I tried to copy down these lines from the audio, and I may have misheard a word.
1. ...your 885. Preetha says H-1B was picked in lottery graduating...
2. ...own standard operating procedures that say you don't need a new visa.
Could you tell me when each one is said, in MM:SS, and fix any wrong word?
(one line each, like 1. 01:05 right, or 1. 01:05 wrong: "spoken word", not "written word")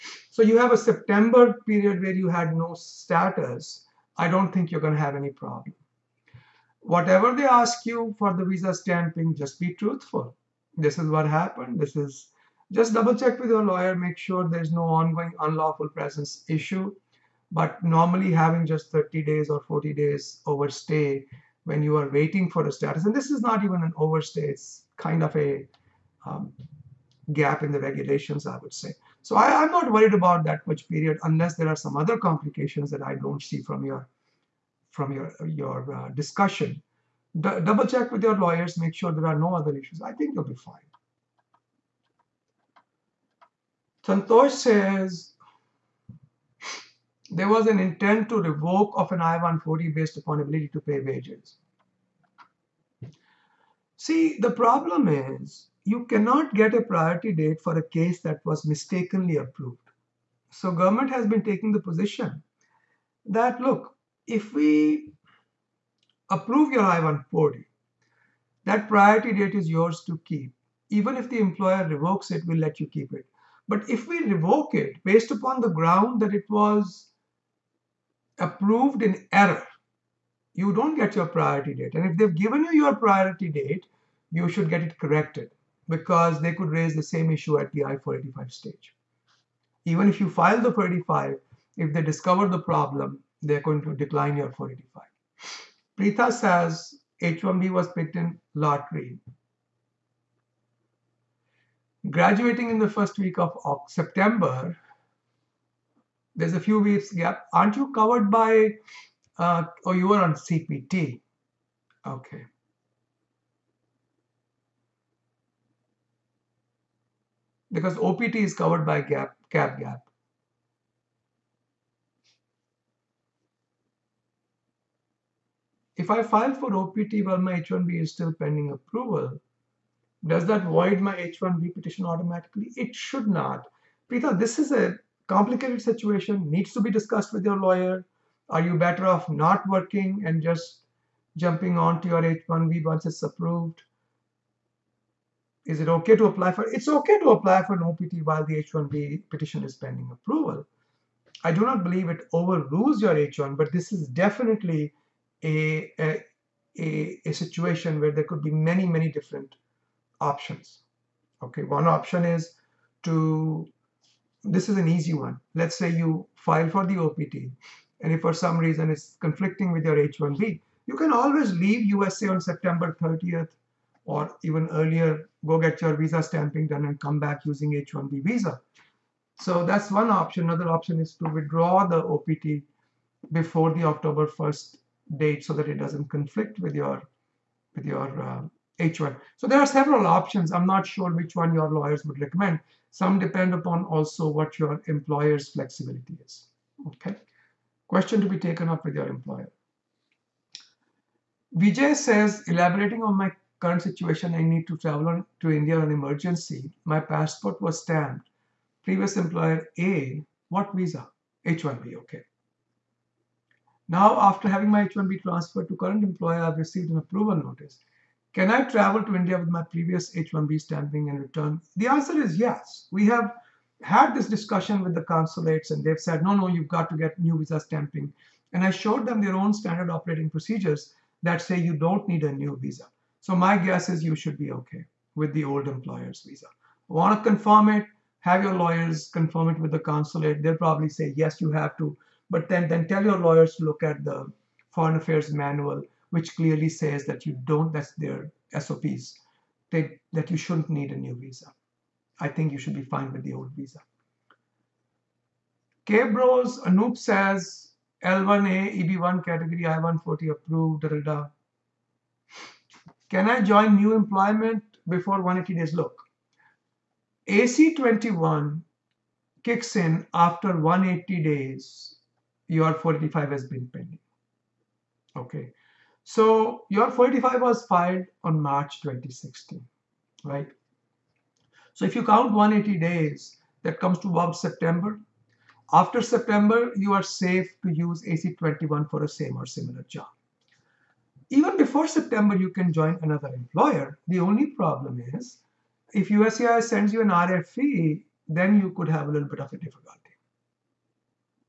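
1. 01:34 wrong: "485", not "885"
2. 03:49 right.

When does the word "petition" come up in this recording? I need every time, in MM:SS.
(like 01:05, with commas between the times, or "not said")
02:11, 02:29.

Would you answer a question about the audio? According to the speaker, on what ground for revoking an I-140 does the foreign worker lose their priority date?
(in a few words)
Approved in error.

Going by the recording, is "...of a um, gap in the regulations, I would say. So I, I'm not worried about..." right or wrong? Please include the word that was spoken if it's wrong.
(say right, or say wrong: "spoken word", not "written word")
right.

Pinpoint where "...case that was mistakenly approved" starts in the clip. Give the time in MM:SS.
00:57.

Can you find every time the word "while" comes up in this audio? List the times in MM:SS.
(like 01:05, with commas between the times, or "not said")
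02:07, 02:28.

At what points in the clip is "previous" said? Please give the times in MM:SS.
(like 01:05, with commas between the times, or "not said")
03:28, 03:39.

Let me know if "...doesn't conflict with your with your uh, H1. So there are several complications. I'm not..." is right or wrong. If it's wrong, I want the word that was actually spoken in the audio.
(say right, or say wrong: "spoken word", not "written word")
wrong: "options", not "complications".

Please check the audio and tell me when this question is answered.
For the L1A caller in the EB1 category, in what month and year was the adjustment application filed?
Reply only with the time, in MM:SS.
04:38.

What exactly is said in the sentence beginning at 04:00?
They'll probably say, yes, you have to.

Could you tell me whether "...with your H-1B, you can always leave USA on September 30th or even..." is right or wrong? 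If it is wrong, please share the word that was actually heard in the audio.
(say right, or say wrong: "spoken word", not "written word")
right.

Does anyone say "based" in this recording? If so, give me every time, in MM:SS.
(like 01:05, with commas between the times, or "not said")
00:49, 01:15.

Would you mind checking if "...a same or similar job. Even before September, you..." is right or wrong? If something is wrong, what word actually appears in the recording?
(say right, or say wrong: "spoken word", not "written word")
right.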